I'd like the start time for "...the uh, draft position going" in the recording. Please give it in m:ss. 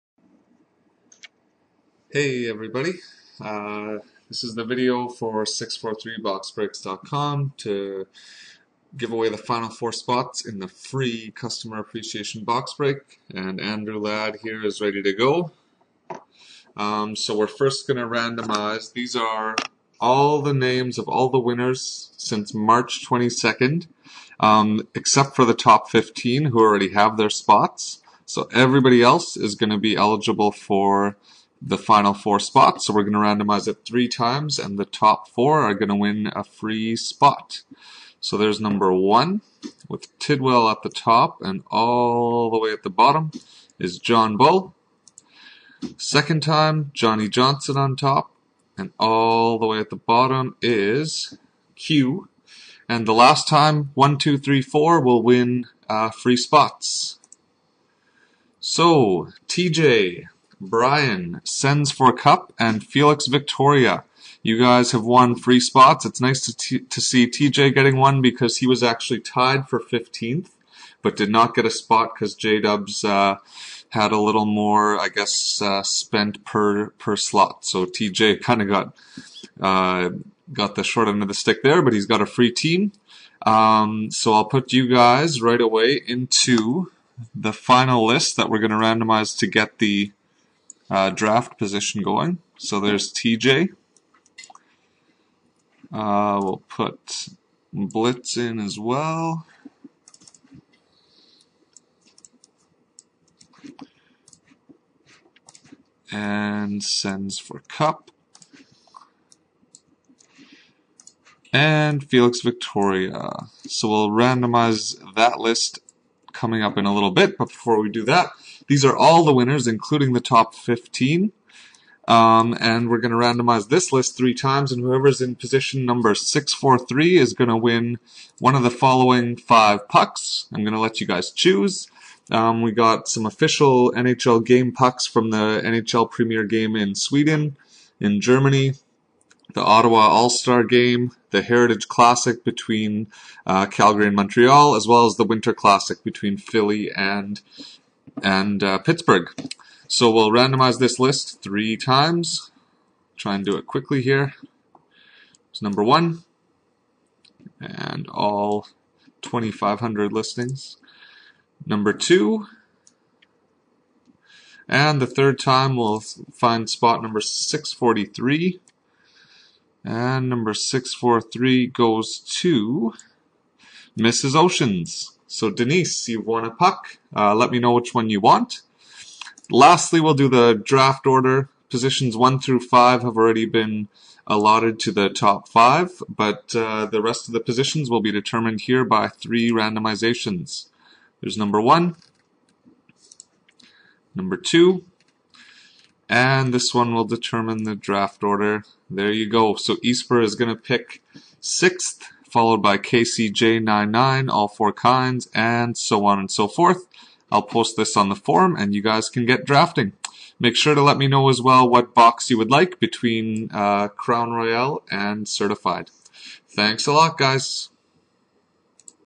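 1:29.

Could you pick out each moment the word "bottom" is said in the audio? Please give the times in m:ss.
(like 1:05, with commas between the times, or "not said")
0:42, 0:49.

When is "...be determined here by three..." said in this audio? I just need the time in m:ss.
3:08.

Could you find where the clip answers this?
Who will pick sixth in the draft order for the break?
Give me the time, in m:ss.
3:19.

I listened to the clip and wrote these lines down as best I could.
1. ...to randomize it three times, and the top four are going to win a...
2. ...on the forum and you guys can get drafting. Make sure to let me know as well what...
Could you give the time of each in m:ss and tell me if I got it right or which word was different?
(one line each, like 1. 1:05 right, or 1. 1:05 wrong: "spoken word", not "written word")
1. 0:33 right
2. 3:27 right.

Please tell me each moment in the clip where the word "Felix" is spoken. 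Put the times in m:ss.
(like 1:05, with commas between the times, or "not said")
1:02, 1:52.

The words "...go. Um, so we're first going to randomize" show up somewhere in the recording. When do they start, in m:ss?
0:15.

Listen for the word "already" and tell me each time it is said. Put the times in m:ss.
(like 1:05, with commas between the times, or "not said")
0:26, 3:03.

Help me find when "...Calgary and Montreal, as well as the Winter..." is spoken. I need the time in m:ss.
2:23.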